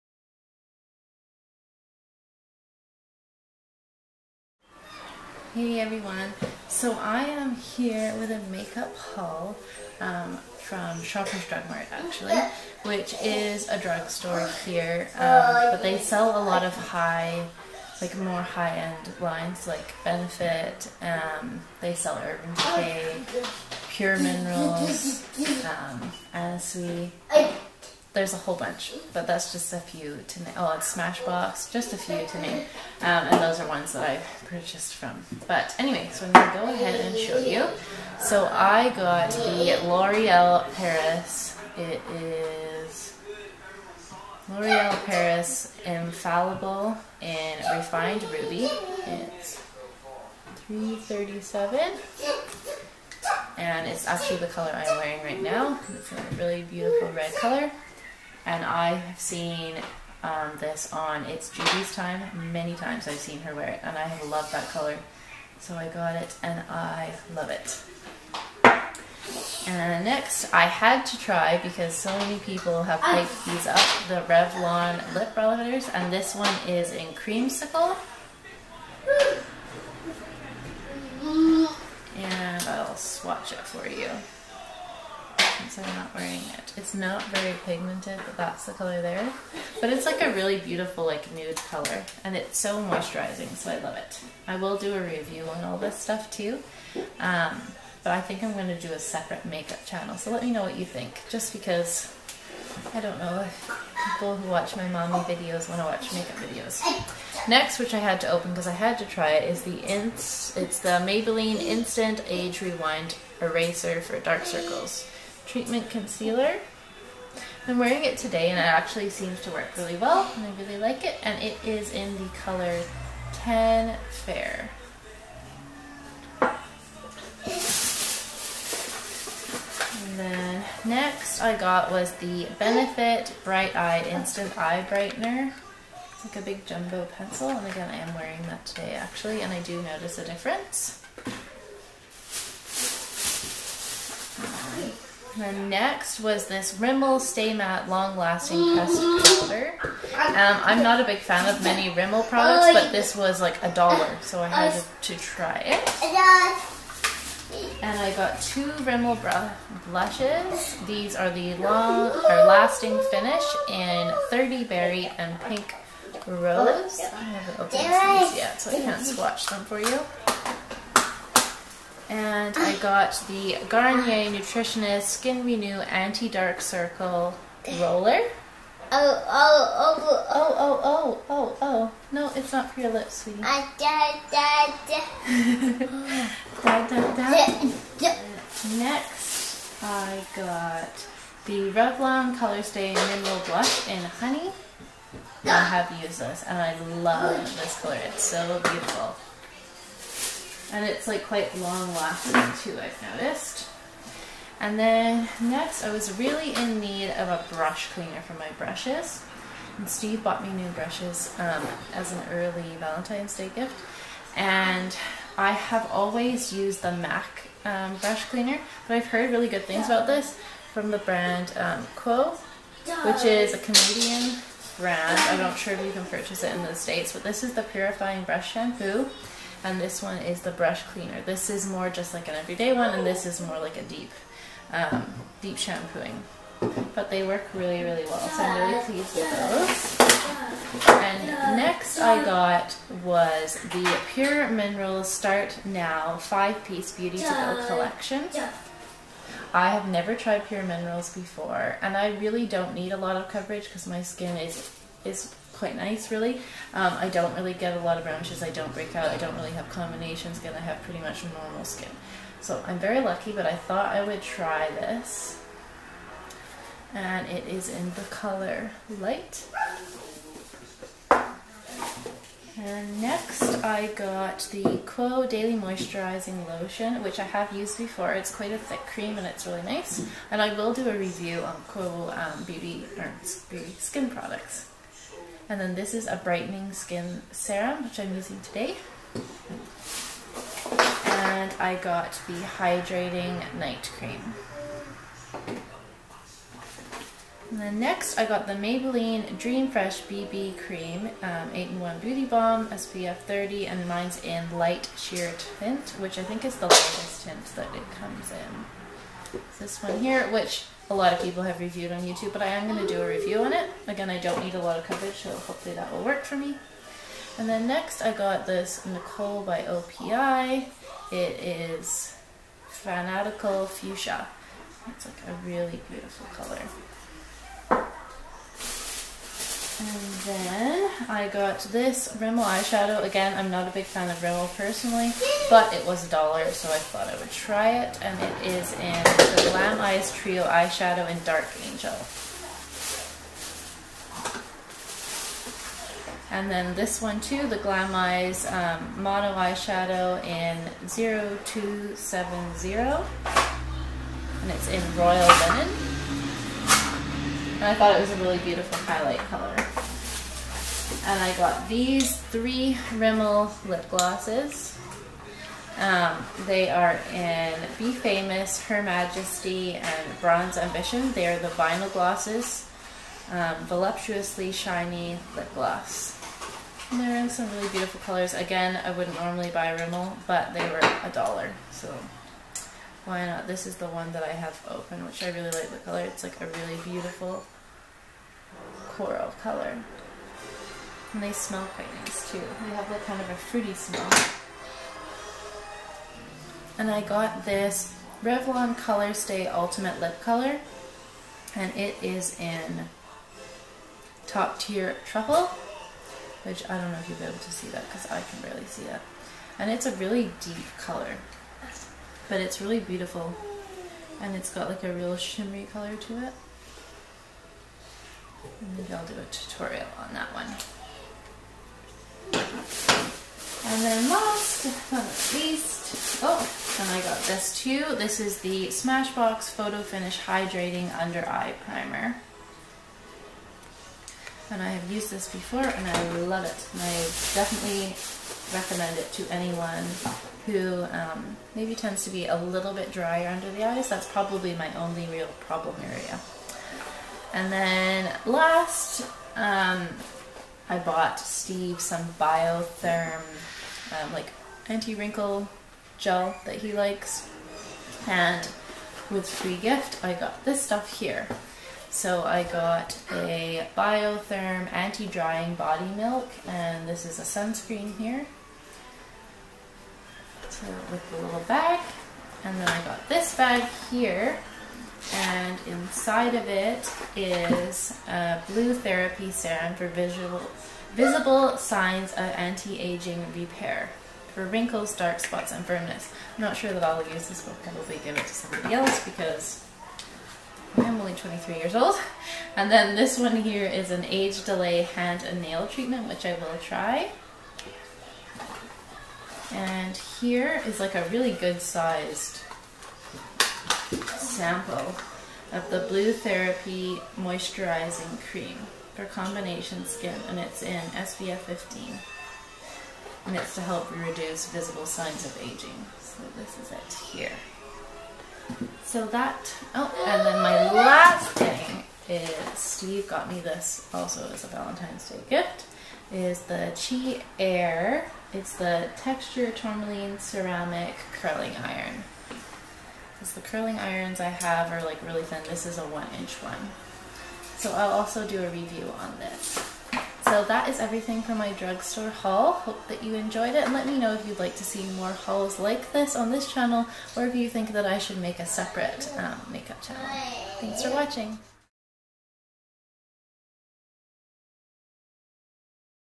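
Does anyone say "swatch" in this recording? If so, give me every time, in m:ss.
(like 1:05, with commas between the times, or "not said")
1:22, 2:49.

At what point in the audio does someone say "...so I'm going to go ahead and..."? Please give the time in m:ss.
0:36.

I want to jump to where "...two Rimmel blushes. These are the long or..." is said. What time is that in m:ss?
2:38.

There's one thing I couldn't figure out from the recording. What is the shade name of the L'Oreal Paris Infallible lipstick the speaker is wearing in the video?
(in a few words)
Refined Ruby.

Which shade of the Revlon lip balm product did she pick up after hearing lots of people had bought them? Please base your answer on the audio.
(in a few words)
Creamsicle.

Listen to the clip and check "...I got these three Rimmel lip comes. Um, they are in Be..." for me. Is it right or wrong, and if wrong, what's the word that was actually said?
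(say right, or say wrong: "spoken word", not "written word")
wrong: "glosses", not "comes".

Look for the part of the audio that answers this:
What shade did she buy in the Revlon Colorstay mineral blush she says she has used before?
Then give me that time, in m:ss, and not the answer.
3:14.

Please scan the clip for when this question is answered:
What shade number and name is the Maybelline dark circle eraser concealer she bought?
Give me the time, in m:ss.
2:03.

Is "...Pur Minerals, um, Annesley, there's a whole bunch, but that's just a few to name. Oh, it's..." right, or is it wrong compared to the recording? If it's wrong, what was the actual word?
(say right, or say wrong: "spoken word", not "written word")
right.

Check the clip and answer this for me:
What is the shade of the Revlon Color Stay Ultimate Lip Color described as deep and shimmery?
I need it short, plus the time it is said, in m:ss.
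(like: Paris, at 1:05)
Top Tier Truffle, at 6:44.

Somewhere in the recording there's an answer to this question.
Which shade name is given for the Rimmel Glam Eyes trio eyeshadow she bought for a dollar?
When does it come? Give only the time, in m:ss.
5:41.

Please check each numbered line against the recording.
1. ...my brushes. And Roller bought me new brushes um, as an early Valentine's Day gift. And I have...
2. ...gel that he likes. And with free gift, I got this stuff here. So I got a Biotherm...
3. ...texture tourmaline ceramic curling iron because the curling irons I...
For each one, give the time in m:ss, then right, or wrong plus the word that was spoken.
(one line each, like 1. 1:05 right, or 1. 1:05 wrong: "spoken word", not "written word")
1. 3:28 wrong: "Steve", not "Roller"
2. 7:35 right
3. 8:48 right.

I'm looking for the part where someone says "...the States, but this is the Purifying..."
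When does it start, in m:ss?
3:46.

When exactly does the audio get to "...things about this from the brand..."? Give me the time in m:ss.
3:39.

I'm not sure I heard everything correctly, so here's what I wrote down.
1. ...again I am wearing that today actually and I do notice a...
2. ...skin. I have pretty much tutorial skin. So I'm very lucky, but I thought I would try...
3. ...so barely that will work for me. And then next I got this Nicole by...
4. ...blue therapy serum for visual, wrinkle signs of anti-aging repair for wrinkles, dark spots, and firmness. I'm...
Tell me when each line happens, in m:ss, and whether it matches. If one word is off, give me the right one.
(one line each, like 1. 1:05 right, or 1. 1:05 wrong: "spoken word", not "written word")
1. 2:17 right
2. 4:20 wrong: "normal", not "tutorial"
3. 5:15 wrong: "hopefully", not "barely"
4. 7:58 wrong: "visible", not "wrinkle".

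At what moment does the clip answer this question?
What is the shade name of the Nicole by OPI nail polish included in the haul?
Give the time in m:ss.
5:22.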